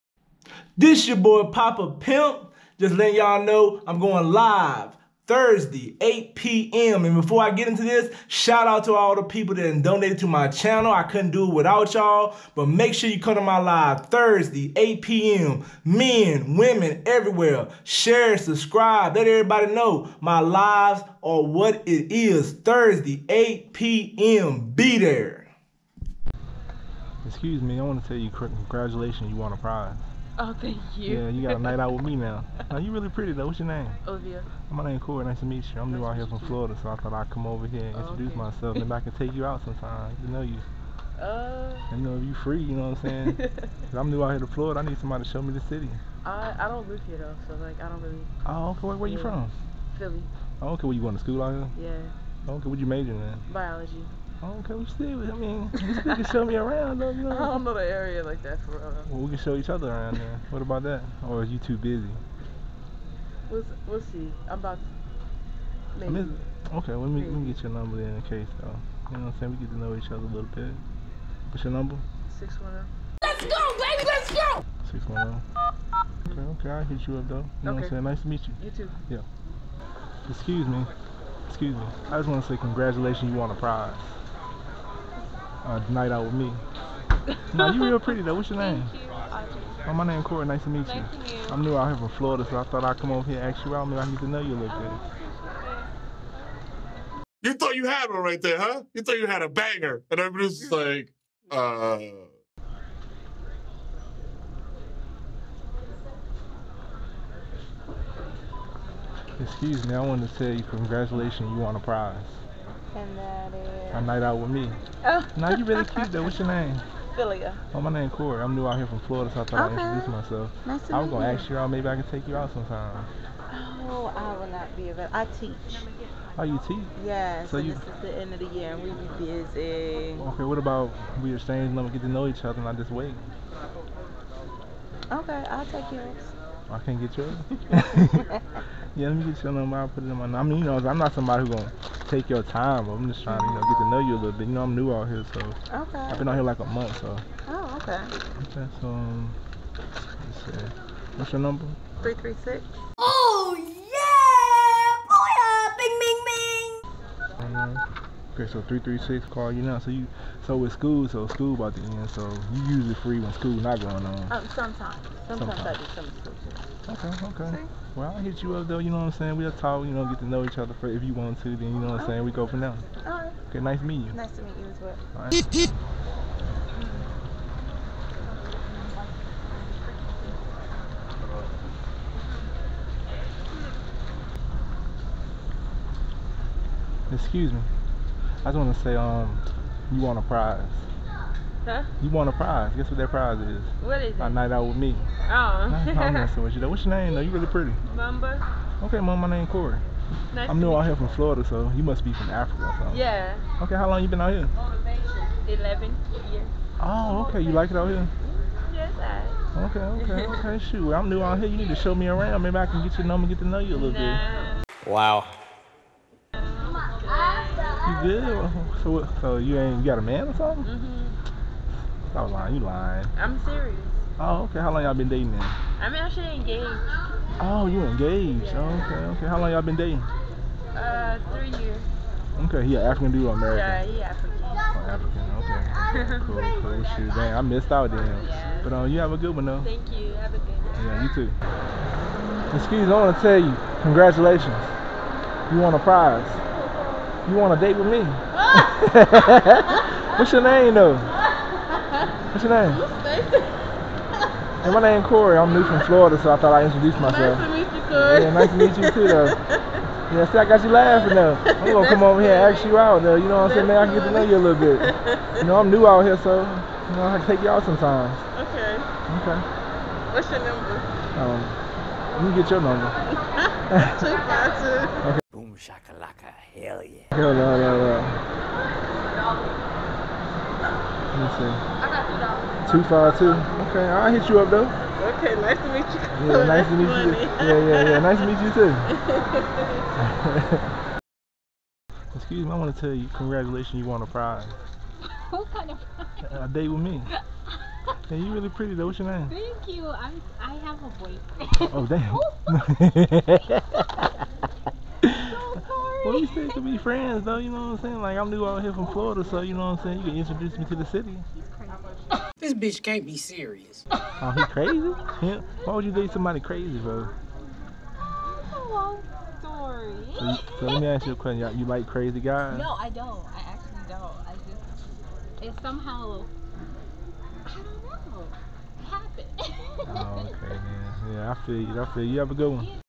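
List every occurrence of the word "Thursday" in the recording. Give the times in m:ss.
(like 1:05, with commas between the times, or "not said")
0:05, 0:14, 0:22.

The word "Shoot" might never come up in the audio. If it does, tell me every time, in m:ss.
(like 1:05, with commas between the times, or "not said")
3:30, 3:56.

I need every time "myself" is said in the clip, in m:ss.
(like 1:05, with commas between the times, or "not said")
0:38, 2:00, 4:17.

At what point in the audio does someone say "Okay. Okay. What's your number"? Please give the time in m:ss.
4:28.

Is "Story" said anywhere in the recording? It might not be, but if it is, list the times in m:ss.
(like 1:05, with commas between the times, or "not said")
5:17.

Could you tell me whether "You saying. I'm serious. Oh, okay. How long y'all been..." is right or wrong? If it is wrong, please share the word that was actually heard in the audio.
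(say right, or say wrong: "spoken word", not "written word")
wrong: "lying", not "saying".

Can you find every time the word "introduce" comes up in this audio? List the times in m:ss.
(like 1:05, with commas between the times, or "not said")
0:37, 1:59, 4:16, 5:10.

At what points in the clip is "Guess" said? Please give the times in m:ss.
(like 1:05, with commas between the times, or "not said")
3:12.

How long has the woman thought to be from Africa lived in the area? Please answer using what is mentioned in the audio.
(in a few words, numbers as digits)
11 years.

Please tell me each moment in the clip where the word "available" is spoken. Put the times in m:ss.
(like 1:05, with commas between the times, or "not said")
2:04.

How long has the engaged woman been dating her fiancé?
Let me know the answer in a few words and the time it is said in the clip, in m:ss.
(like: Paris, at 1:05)
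3 years, at 3:51.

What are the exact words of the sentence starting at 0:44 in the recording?
I need somebody to show me the city.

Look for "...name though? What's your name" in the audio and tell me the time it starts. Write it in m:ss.
4:10.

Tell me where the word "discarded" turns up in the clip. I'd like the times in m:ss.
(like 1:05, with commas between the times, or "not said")
not said.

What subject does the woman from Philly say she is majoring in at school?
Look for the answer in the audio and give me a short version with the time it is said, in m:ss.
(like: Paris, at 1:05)
Biology, at 0:53.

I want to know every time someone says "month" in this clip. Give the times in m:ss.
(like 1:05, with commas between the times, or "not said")
2:26.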